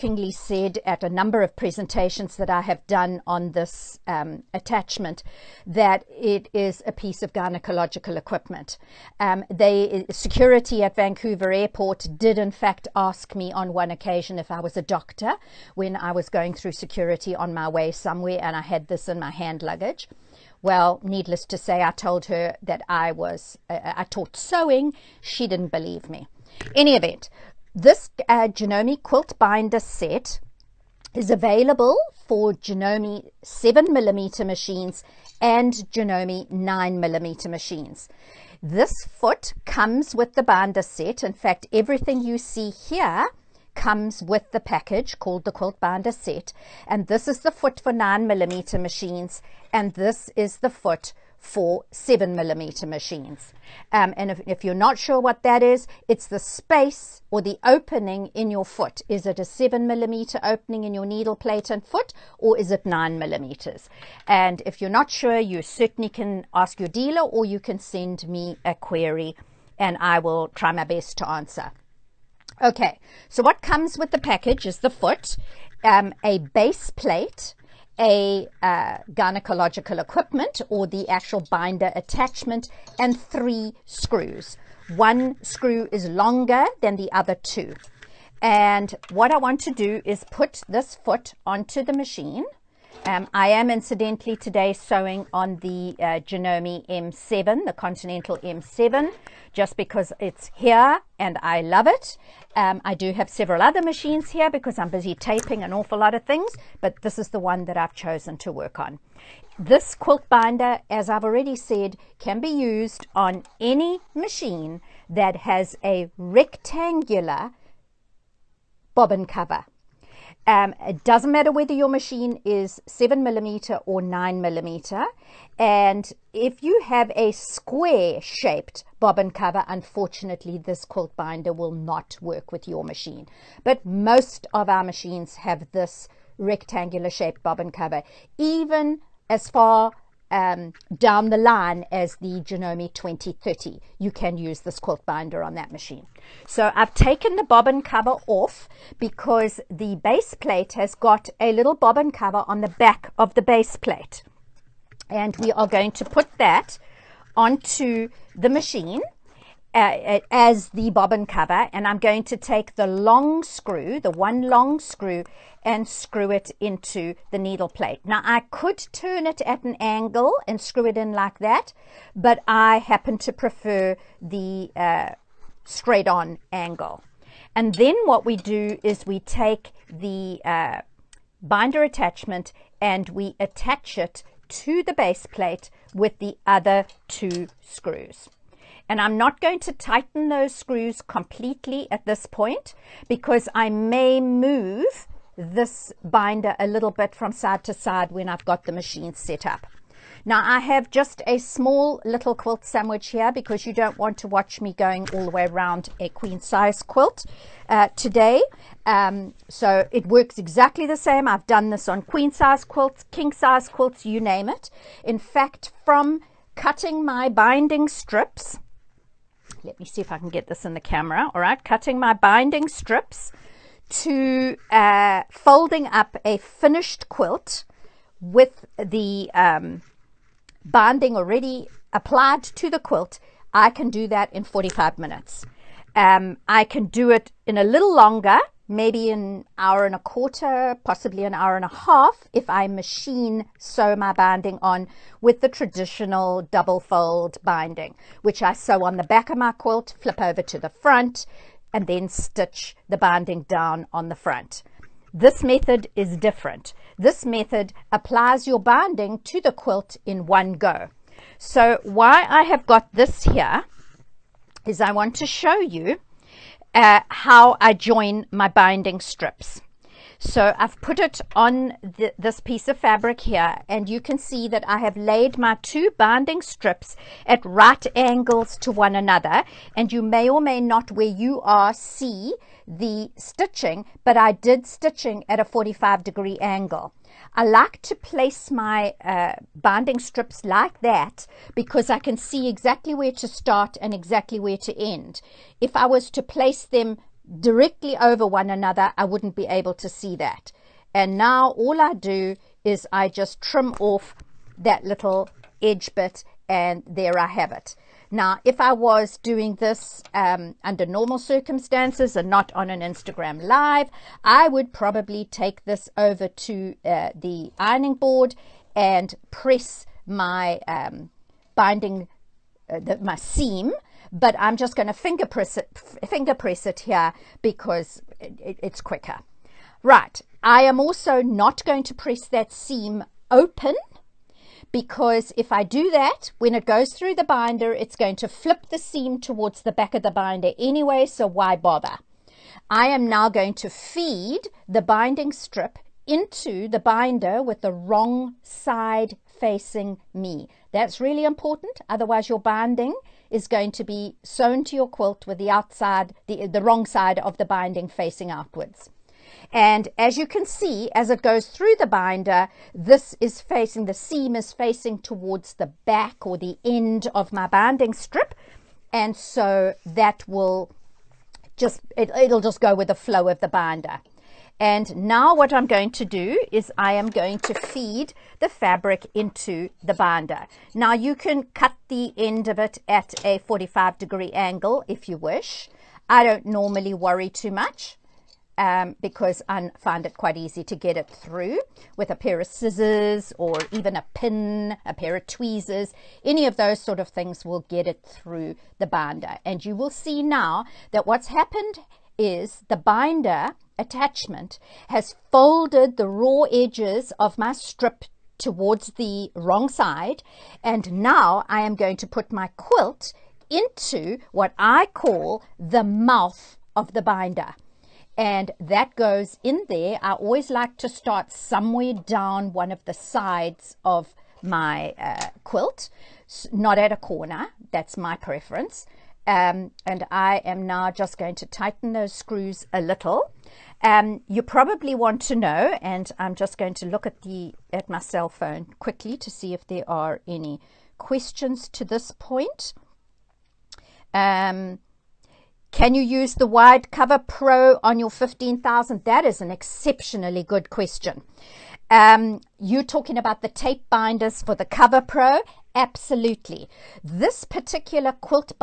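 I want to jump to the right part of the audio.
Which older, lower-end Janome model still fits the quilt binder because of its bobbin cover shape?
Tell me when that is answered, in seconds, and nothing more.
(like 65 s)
142 s.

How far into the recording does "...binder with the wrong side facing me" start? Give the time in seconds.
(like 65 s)
346 s.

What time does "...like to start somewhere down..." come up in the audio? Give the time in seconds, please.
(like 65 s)
420 s.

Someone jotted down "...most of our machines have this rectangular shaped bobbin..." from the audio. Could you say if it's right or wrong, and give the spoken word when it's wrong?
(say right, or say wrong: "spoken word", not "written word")
right.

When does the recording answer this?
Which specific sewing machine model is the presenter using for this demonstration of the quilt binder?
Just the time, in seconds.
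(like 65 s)
96 s.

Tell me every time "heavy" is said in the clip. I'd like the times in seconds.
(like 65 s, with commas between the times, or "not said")
not said.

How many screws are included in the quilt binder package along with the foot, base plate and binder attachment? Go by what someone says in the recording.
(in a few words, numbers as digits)
3.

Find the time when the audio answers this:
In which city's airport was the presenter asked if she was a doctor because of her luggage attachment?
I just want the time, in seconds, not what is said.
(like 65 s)
10 s.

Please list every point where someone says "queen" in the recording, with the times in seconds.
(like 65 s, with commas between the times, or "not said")
206 s, 212 s.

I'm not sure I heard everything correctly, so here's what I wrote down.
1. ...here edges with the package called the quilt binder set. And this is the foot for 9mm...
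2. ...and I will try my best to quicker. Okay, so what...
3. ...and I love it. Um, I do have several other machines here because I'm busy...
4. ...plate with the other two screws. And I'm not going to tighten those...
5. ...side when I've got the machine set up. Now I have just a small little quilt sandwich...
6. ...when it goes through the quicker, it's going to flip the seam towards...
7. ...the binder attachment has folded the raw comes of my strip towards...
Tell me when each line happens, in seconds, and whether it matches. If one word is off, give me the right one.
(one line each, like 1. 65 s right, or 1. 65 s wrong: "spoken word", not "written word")
1. 42 s wrong: "comes", not "edges"
2. 69 s wrong: "answer", not "quicker"
3. 101 s right
4. 185 s right
5. 197 s right
6. 336 s wrong: "binder", not "quicker"
7. 402 s wrong: "edges", not "comes".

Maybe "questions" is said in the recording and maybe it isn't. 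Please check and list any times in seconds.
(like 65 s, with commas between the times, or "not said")
440 s, 450 s.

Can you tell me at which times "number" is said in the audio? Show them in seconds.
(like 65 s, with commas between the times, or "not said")
1 s.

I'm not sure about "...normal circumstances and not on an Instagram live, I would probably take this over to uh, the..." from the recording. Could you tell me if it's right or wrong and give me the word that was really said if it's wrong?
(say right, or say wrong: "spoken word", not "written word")
right.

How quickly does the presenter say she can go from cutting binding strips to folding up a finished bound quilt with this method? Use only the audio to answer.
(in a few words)
45 minutes.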